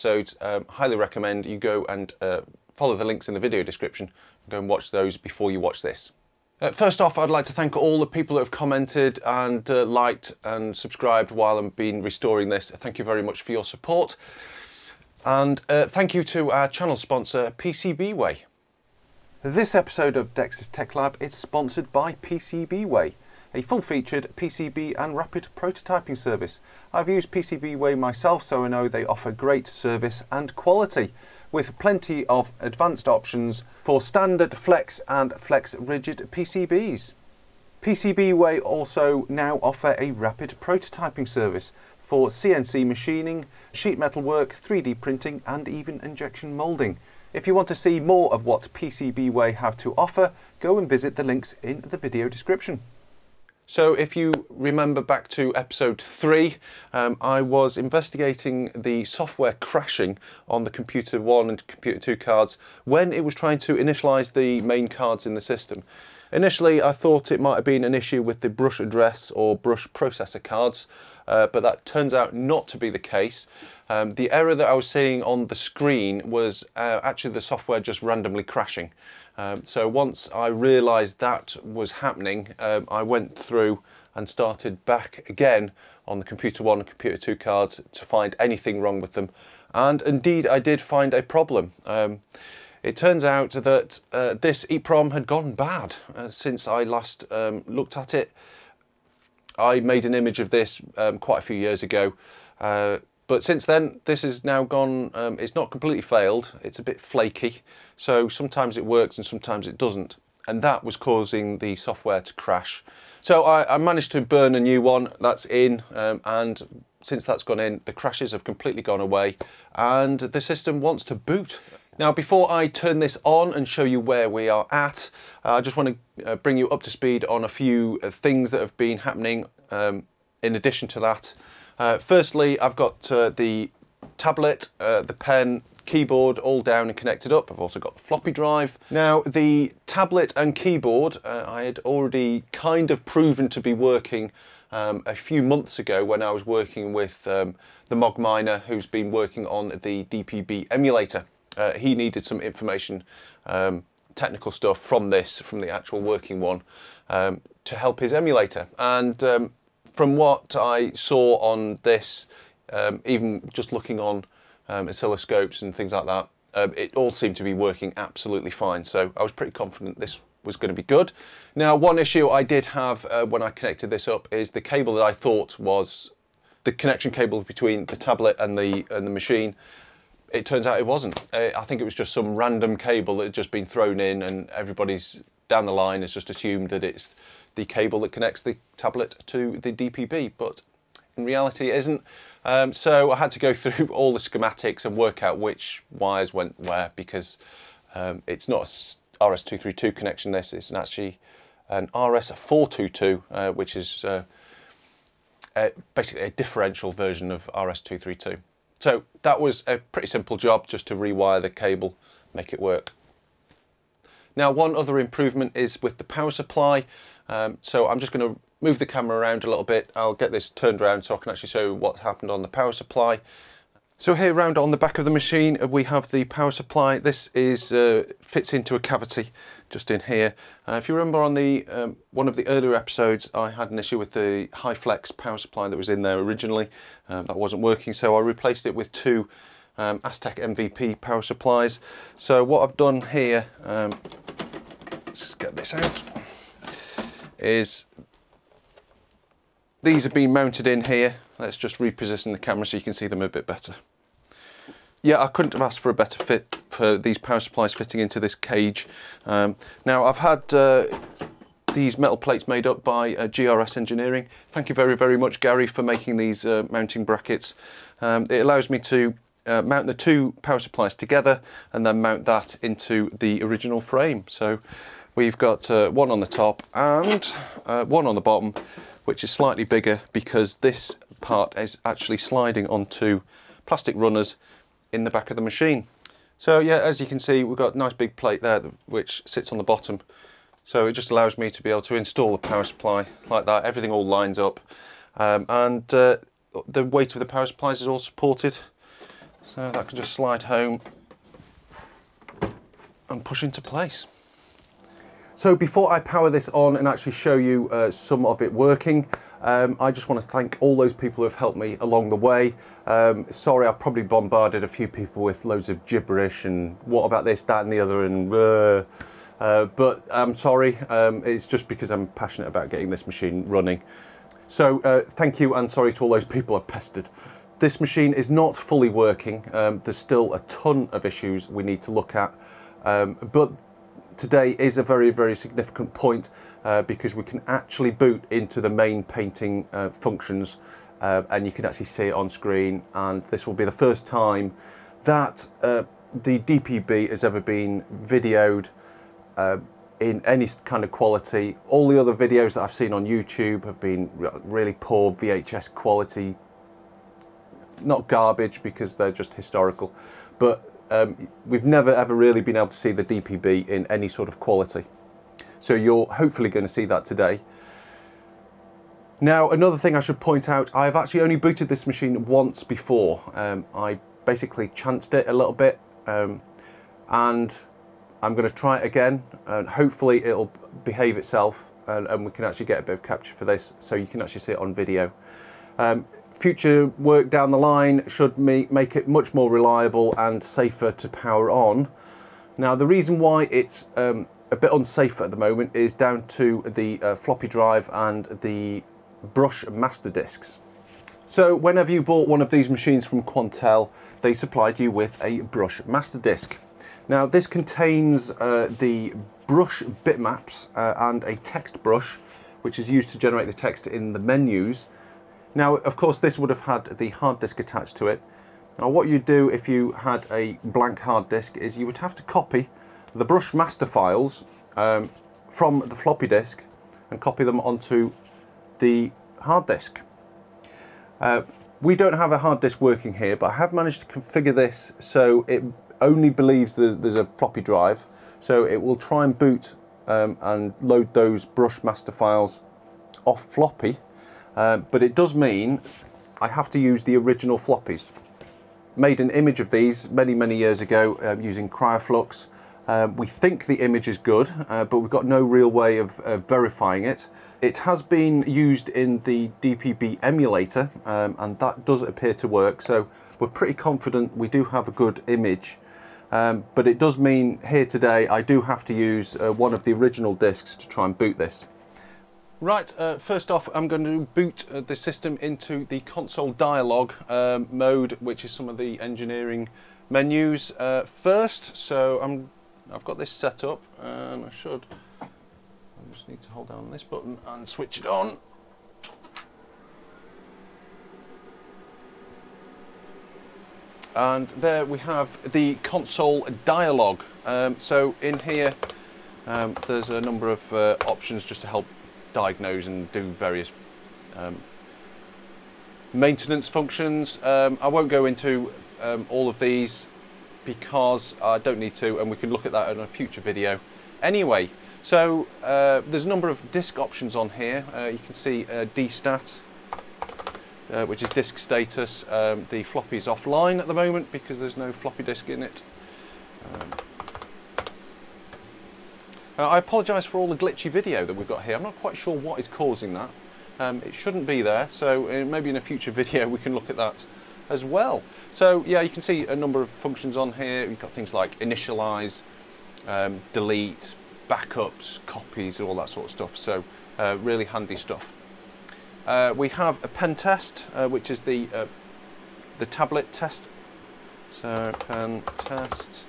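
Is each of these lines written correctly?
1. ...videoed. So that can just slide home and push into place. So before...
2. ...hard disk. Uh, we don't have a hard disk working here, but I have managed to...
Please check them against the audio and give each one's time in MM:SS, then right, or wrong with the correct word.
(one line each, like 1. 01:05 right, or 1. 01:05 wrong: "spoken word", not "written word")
1. 04:57 wrong: "supported", not "videoed"
2. 07:09 right.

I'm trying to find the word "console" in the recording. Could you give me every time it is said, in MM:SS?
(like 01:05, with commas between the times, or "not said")
07:56, 08:15.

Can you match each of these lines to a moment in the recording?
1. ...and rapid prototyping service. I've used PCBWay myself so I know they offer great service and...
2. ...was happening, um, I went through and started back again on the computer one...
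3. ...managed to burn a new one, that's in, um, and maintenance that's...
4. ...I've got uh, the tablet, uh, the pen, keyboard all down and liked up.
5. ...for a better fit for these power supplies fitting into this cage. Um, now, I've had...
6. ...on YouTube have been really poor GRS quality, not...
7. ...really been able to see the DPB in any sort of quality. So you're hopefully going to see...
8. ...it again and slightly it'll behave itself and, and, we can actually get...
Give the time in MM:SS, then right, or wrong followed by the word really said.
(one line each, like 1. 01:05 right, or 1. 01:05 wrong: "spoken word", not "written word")
1. 00:24 right
2. 01:21 right
3. 01:53 wrong: "since", not "maintenance"
4. 02:12 wrong: "connected", not "liked"
5. 04:15 right
6. 05:52 wrong: "VHS", not "GRS"
7. 06:02 right
8. 06:18 wrong: "hopefully", not "slightly".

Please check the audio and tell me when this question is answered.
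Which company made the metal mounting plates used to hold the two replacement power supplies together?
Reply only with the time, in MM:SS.
04:23.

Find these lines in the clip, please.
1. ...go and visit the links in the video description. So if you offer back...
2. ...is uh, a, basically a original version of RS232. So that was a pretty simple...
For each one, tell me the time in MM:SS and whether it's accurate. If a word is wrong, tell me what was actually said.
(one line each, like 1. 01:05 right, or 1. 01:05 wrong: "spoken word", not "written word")
1. 00:50 wrong: "remember", not "offer"
2. 03:23 wrong: "differential", not "original".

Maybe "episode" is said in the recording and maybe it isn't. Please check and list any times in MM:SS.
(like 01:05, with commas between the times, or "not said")
00:19, 00:55, 03:52.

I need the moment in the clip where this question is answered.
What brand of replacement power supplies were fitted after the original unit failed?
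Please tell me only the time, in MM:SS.
03:59.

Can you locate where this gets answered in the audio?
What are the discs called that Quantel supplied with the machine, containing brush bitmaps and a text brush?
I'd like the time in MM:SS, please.
06:39.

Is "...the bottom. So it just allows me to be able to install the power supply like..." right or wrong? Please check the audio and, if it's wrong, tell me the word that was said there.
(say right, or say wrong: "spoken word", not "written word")
right.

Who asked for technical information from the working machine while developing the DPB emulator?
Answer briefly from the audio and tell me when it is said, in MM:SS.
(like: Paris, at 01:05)
the Mog Miner, at 02:27.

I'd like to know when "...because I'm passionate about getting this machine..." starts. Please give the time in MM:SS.
05:21.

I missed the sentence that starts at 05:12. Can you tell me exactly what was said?
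Um, sorry, I probably bombarded a few people with loads of gibberish and what about this, that and the other and...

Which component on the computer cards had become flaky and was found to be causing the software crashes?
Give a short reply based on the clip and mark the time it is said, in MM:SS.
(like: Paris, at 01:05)
EEPROM, at 01:34.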